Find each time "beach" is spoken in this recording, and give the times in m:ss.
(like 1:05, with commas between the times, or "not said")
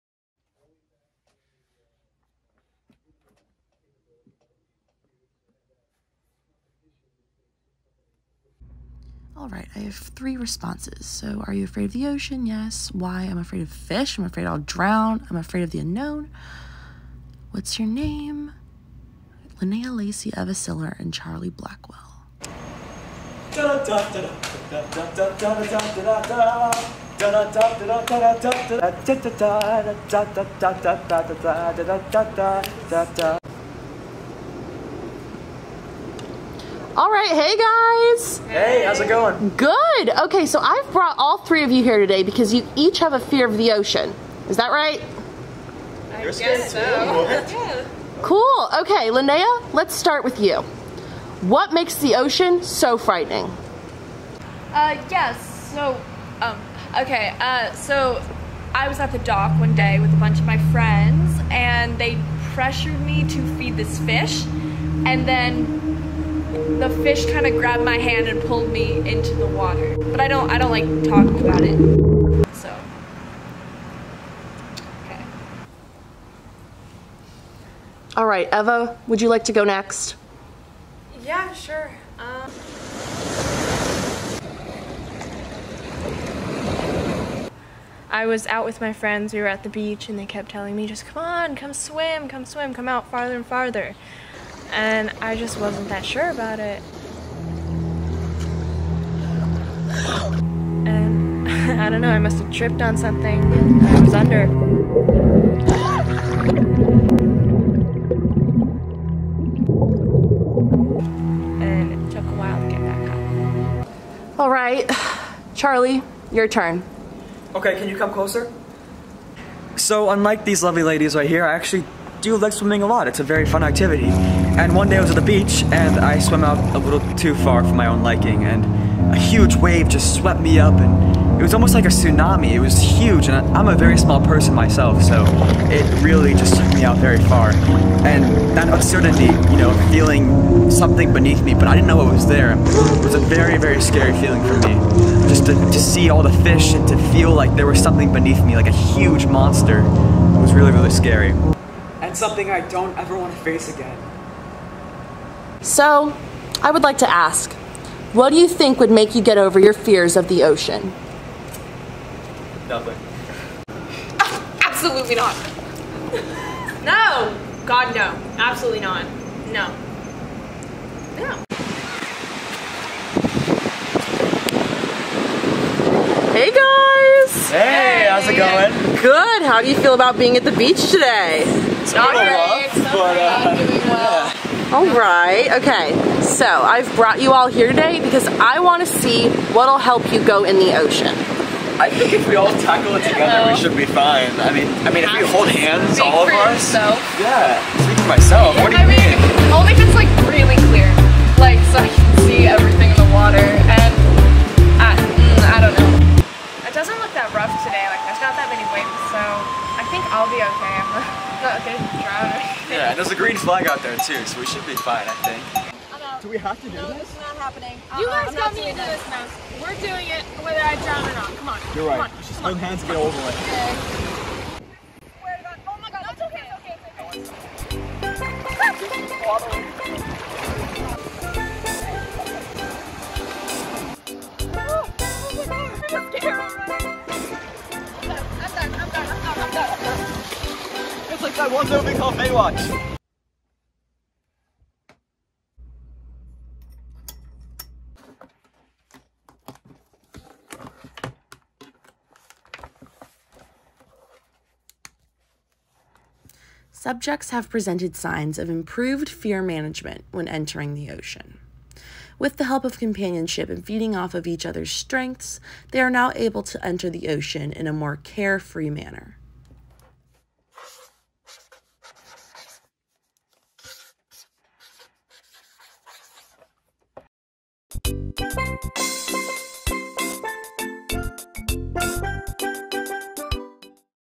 1:29, 2:05, 3:00.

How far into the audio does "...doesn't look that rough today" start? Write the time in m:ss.
3:26.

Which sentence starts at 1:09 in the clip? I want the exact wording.
But I don't, I don't like talking about it.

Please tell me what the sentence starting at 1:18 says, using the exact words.
All right, Eva, would you like to go next?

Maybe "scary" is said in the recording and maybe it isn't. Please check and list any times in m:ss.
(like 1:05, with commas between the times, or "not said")
2:23, 2:30.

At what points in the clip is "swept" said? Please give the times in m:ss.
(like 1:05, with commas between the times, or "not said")
2:10.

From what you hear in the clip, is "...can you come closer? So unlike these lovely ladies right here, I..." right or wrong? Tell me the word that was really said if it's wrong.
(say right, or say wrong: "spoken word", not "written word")
right.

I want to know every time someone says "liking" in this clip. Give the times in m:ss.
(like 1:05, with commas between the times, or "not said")
2:08.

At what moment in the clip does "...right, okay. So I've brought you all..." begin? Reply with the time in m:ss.
3:04.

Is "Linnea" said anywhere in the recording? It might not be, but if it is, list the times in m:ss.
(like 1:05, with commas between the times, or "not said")
0:19, 0:49.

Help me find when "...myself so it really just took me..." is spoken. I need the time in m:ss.
2:14.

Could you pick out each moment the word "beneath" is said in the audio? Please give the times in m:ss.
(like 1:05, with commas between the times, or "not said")
2:21, 2:28.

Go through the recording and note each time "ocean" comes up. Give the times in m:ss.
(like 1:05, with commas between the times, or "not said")
0:12, 0:43, 0:52, 2:40, 3:10, 4:20, 4:27.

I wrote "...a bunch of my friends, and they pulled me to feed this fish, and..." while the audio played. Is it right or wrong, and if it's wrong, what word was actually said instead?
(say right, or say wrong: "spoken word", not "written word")
wrong: "pressured", not "pulled".